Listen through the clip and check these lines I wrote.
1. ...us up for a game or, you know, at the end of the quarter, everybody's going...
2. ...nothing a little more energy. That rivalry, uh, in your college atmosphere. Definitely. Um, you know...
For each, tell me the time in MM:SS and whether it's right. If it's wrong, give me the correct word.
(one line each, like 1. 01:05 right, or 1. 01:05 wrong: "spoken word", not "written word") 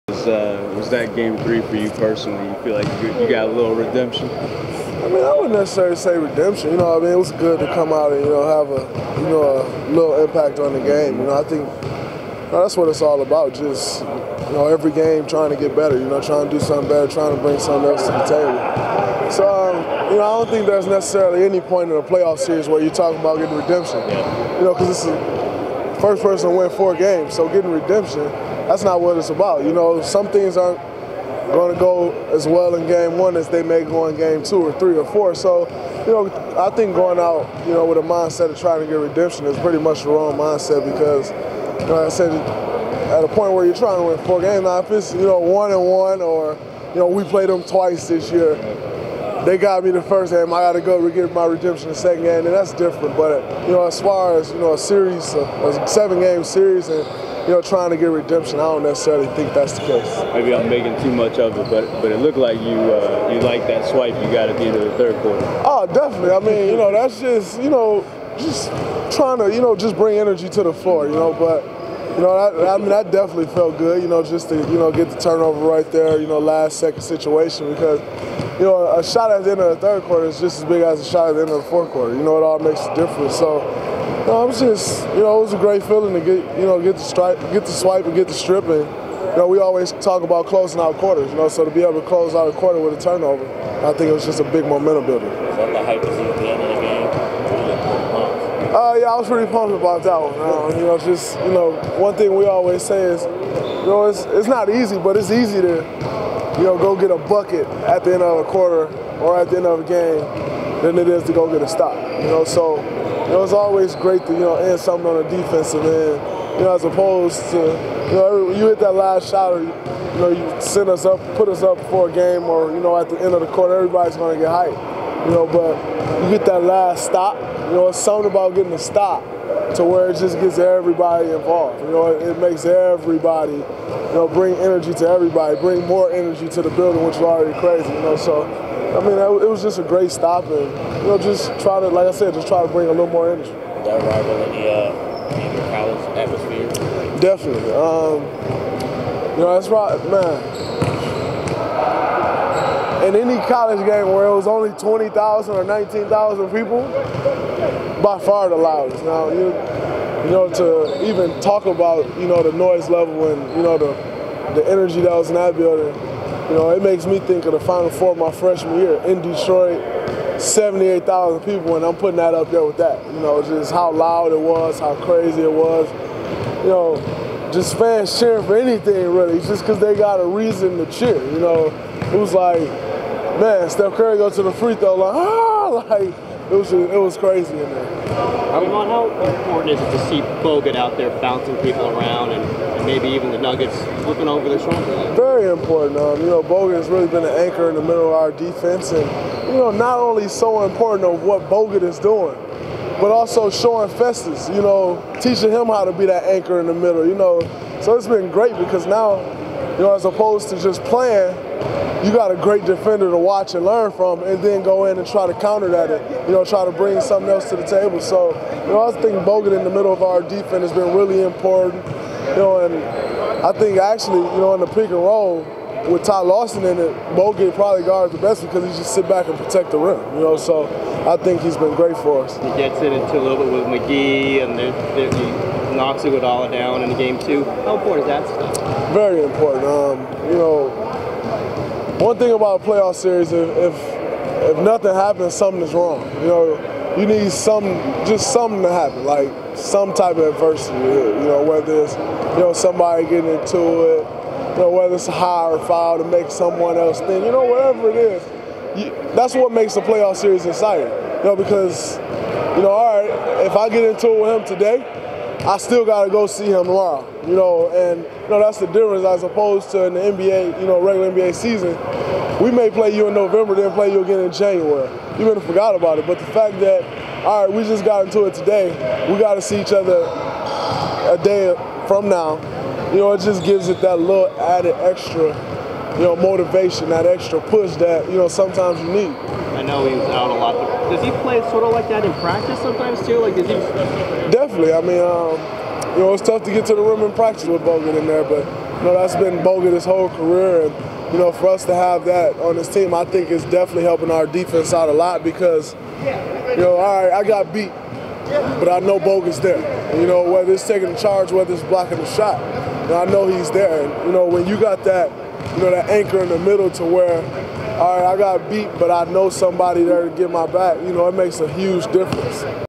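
1. 02:01 right
2. 02:22 wrong: "bring", not "nothing".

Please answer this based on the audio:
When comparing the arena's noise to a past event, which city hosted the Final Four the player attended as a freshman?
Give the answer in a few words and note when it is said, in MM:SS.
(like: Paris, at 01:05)
Detroit, at 02:49.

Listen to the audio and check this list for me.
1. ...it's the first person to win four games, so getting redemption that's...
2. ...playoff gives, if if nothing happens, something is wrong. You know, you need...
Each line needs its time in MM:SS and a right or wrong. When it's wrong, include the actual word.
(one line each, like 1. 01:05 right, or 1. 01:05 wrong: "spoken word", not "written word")
1. 00:24 right
2. 04:02 wrong: "series", not "gives".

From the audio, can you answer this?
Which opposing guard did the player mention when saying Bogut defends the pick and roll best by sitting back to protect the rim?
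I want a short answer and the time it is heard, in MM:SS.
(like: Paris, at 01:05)
Ty Lawson, at 03:46.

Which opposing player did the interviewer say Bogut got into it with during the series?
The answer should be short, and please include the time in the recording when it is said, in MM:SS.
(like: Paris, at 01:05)
McGee, at 03:53.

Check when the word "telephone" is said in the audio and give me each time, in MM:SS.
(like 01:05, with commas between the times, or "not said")
not said.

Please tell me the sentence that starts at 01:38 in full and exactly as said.
Uh, yeah, I was pretty pumped about that one.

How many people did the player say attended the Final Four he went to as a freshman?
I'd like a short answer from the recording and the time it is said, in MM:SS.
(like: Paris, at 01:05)
78,000, at 02:50.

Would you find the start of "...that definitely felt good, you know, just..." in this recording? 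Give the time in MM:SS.
01:12.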